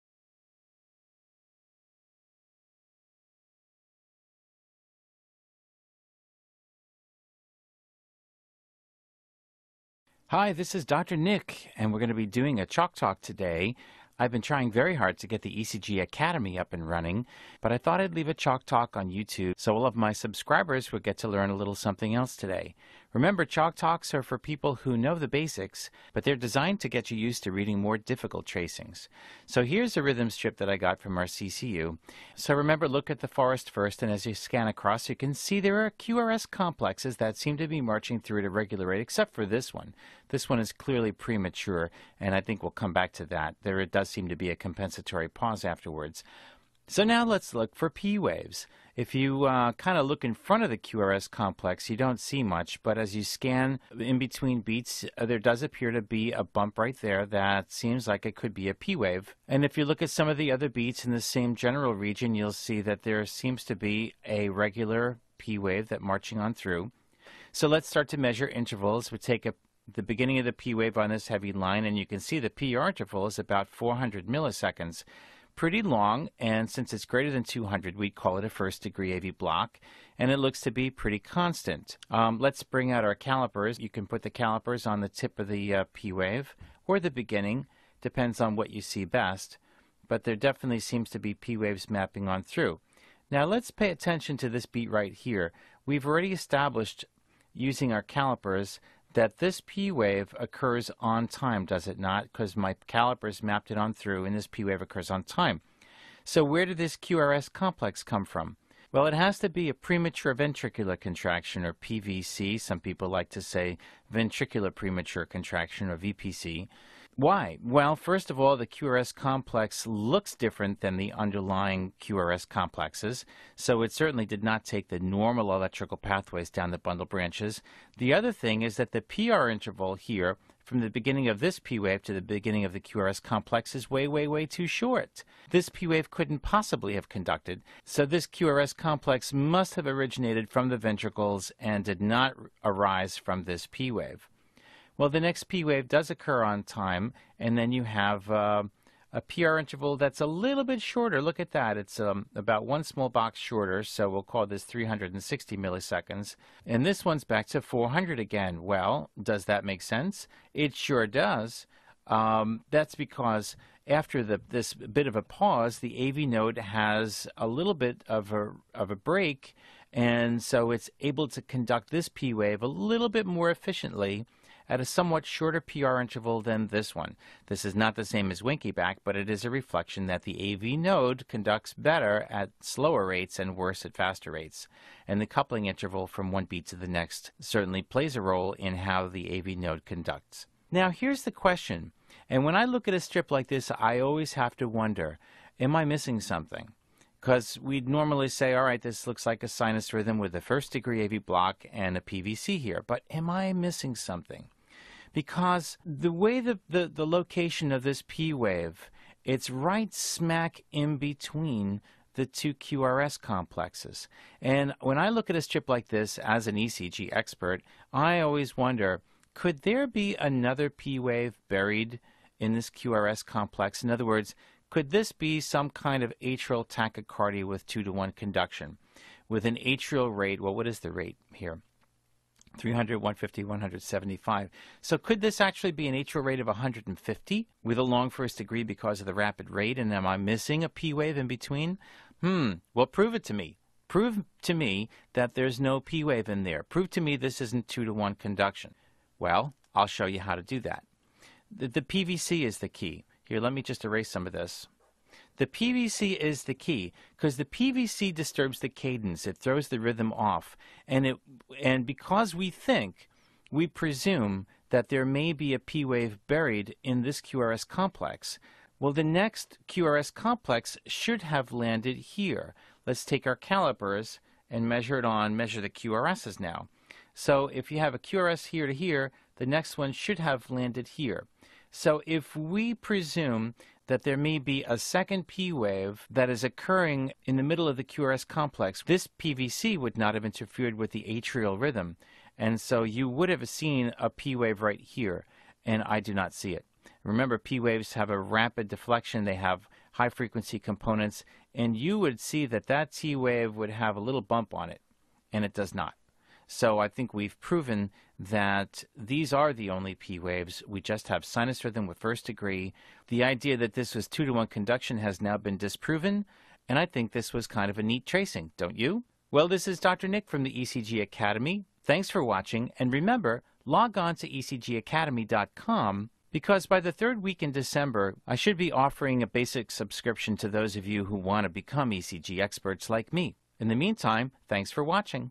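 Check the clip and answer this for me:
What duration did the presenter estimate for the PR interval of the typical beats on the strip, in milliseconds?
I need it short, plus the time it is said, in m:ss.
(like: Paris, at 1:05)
400 milliseconds, at 1:13.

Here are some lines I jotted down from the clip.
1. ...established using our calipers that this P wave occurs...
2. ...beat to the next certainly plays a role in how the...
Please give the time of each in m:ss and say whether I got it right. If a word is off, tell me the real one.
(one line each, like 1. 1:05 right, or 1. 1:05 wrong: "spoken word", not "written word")
1. 1:36 right
2. 3:06 right.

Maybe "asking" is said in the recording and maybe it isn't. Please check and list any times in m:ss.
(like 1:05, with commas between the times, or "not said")
not said.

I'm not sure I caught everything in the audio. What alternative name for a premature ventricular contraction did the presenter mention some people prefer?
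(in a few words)
VPC.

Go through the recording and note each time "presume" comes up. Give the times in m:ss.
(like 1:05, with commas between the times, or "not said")
4:23, 4:42.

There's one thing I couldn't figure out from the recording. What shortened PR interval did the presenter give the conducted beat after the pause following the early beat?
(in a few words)
360 milliseconds.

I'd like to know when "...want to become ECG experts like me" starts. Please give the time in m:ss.
5:31.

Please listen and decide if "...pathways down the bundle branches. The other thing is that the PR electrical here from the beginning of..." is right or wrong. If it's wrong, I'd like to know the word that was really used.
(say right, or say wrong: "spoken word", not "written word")
wrong: "interval", not "electrical".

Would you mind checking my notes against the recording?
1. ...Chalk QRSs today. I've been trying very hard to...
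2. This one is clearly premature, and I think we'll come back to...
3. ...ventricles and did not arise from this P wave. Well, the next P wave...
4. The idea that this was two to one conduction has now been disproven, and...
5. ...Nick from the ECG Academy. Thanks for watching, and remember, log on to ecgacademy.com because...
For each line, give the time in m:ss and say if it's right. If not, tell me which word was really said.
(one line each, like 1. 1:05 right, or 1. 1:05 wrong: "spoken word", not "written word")
1. 0:12 wrong: "Talk", not "QRSs"
2. 0:40 right
3. 2:20 right
4. 5:13 right
5. 5:20 right.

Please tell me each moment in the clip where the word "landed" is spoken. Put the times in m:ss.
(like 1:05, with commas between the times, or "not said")
4:31, 4:40.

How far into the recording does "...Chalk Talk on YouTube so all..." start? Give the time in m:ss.
0:18.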